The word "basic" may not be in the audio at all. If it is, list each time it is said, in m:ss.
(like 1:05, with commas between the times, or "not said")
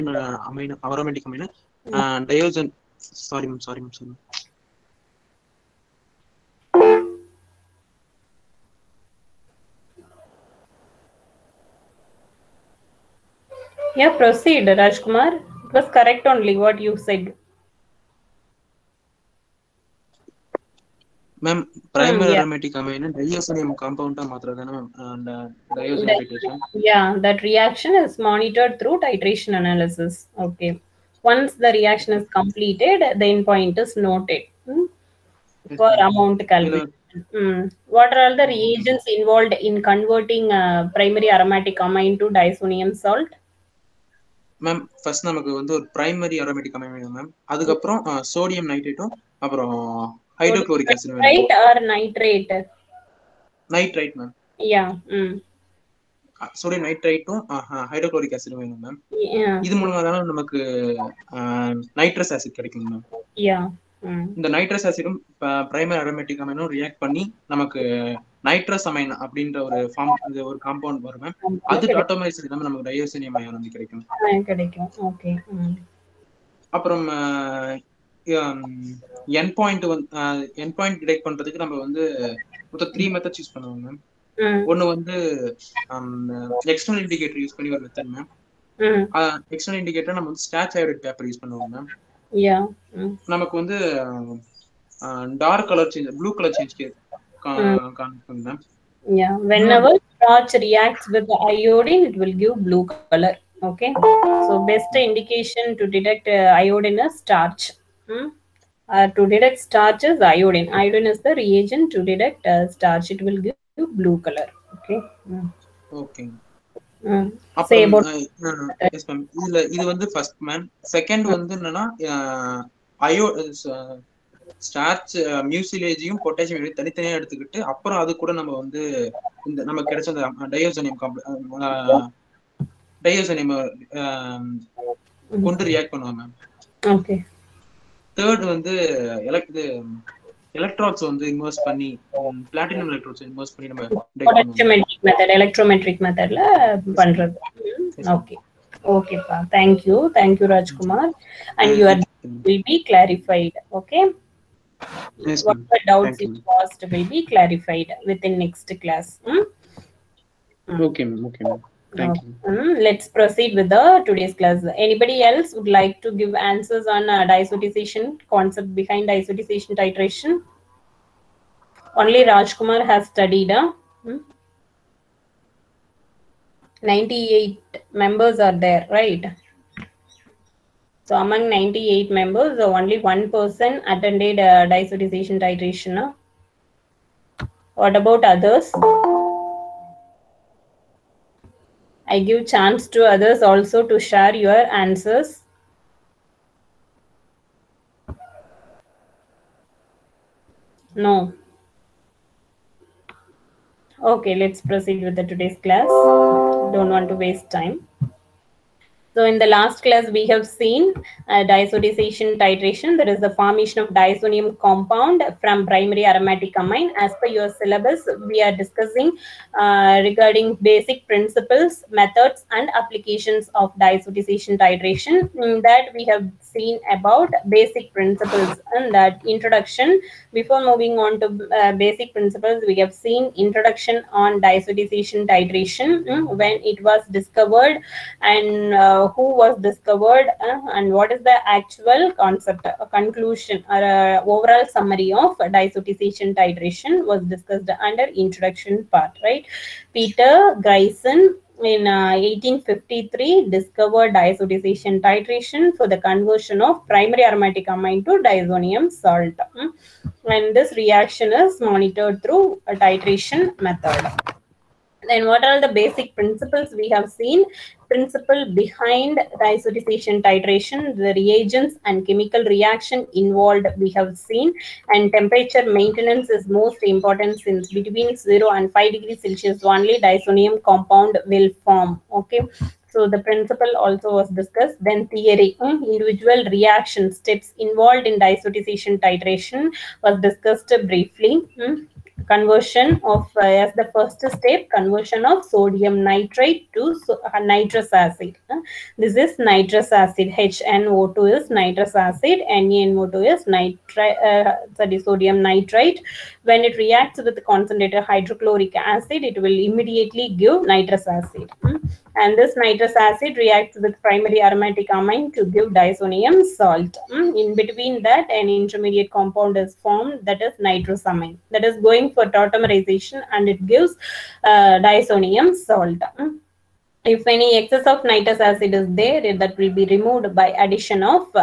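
3:40, 3:47, 3:51, 4:25.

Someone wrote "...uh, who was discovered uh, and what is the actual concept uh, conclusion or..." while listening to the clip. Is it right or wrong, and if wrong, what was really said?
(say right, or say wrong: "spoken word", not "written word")
right.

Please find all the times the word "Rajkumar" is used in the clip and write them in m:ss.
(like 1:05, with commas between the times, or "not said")
0:14, 2:52.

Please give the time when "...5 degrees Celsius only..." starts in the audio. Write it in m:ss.
4:38.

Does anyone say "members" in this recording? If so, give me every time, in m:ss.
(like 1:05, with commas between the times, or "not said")
2:57, 3:02.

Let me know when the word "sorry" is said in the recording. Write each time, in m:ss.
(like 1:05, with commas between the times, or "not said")
5:04.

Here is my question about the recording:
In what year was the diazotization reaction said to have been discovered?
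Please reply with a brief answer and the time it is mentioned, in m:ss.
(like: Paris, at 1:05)
1853, at 4:11.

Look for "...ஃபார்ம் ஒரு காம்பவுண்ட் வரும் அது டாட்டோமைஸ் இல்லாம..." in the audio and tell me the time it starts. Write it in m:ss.
1:09.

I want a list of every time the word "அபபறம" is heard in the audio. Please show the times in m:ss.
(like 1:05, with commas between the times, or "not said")
0:49, 1:16, 2:07.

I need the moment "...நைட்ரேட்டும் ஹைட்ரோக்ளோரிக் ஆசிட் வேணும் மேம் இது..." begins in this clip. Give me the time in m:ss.
0:56.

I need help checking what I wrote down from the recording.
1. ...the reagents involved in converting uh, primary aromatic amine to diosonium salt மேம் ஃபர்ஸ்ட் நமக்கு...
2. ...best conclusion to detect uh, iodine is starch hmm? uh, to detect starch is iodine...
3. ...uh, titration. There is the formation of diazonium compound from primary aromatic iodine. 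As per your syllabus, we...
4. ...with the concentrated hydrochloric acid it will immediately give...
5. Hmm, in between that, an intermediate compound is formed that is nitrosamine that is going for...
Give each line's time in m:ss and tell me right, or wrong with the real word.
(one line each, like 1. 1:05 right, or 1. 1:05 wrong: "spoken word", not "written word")
1. 0:38 right
2. 1:44 wrong: "indication", not "conclusion"
3. 3:31 wrong: "amine", not "iodine"
4. 5:07 right
5. 5:17 right.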